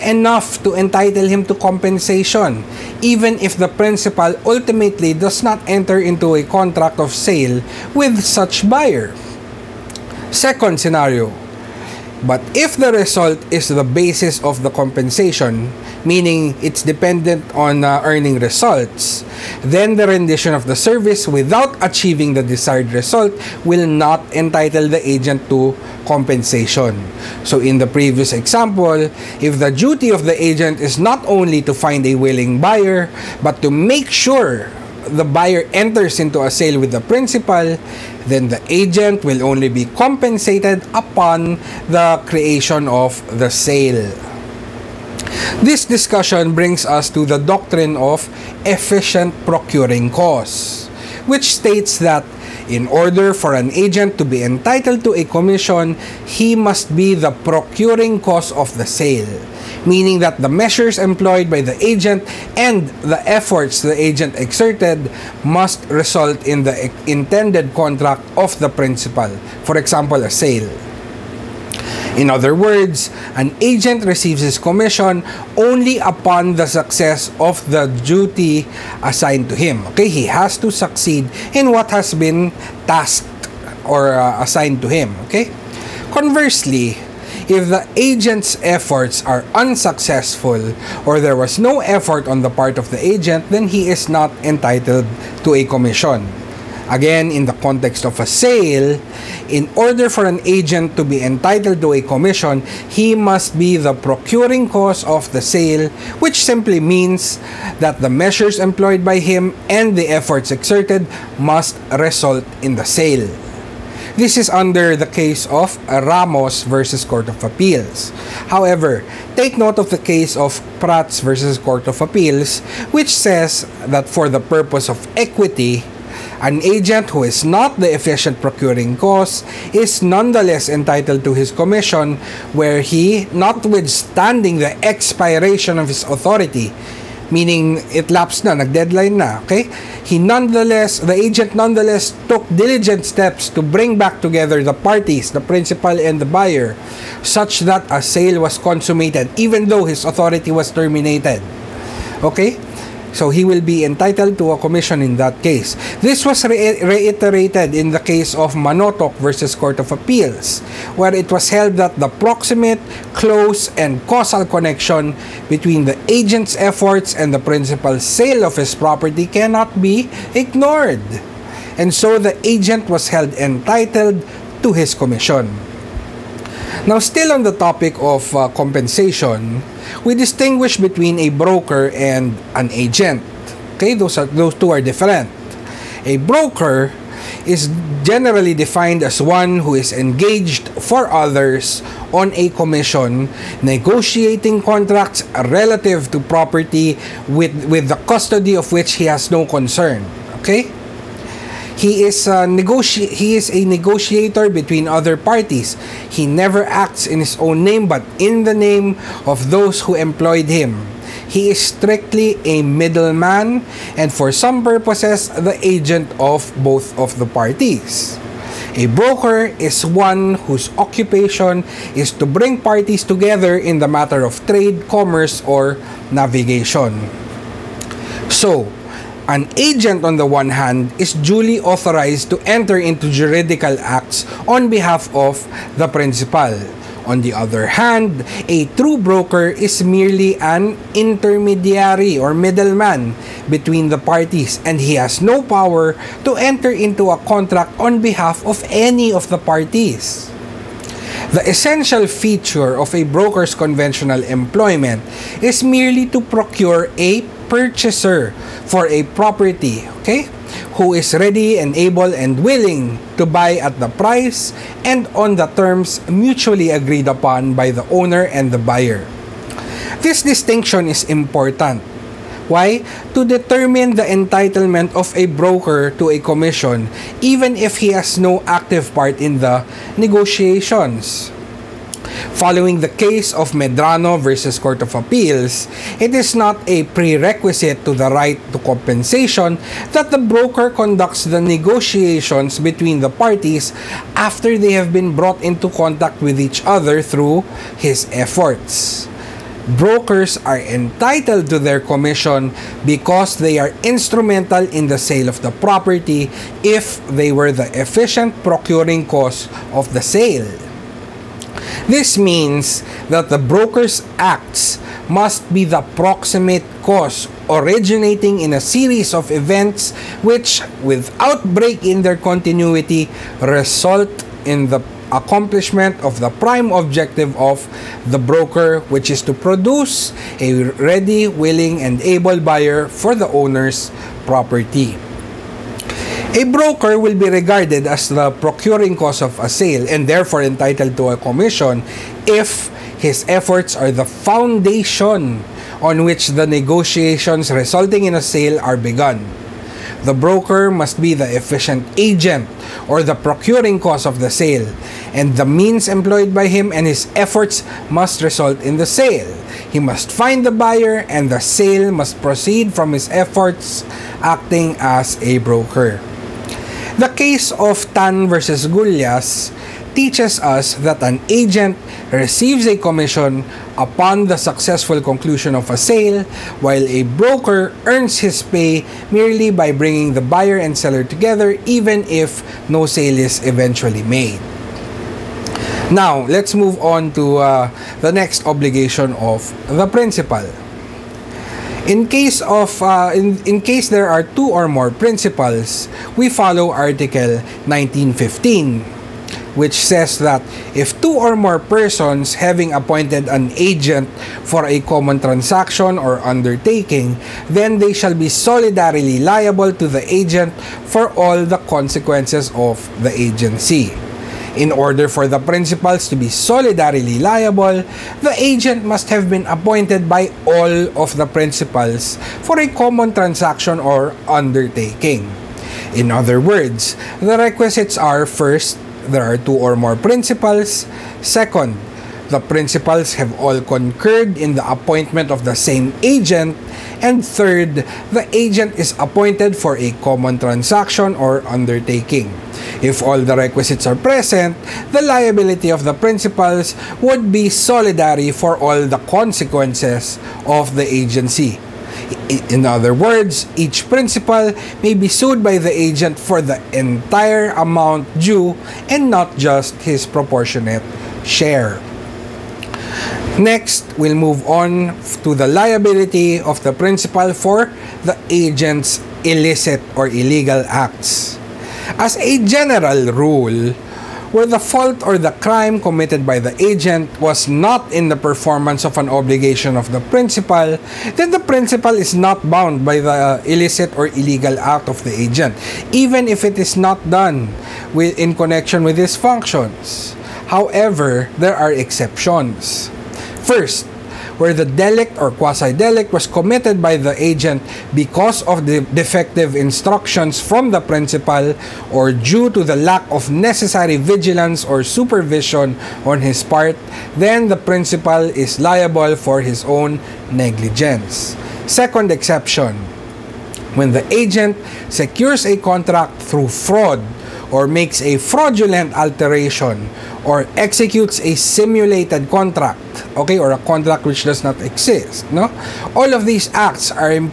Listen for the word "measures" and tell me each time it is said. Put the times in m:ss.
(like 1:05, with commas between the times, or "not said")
1:00, 1:48.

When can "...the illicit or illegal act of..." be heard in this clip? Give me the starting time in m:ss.
8:02.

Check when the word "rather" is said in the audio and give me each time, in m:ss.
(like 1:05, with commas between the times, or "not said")
not said.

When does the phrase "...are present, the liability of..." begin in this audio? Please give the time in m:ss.
7:23.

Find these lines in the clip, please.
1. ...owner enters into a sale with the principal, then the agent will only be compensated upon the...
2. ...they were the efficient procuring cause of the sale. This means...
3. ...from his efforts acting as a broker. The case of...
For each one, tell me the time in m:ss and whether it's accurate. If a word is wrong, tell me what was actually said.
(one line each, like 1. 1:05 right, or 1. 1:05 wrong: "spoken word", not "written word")
1. 0:35 wrong: "buyer", not "owner"
2. 5:07 right
3. 6:02 right.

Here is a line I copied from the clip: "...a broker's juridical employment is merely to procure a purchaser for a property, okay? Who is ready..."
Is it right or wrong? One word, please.
wrong.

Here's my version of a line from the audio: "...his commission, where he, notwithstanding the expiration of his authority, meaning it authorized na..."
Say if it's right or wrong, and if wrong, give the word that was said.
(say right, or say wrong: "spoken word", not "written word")
wrong: "lapsed", not "authorized".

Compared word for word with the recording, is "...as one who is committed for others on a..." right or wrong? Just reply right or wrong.
wrong.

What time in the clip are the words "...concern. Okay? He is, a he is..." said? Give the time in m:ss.
3:19.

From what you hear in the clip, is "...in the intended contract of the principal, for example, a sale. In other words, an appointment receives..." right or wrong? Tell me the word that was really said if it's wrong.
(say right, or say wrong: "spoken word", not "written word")
wrong: "agent", not "appointment".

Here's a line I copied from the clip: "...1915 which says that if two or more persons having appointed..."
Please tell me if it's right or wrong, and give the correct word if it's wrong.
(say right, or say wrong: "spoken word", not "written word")
right.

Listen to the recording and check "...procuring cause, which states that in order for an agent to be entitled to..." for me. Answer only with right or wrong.
right.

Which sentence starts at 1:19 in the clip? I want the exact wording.
Okay, he has to succeed in what has been tasked or uh, assigned to him.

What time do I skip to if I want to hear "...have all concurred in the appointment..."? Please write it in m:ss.
7:13.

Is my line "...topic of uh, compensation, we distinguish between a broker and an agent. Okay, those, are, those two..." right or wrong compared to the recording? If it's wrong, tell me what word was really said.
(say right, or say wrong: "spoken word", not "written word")
right.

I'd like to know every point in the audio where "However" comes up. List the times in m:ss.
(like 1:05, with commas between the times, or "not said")
1:58, 8:10.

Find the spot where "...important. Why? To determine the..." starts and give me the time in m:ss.
4:31.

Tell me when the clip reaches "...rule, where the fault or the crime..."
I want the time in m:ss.
7:53.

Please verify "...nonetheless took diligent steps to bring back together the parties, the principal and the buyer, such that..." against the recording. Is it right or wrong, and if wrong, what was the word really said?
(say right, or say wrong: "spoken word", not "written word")
right.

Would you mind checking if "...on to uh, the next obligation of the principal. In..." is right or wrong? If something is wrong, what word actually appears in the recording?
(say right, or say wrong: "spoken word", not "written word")
right.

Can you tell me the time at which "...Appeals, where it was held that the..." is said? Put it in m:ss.
2:39.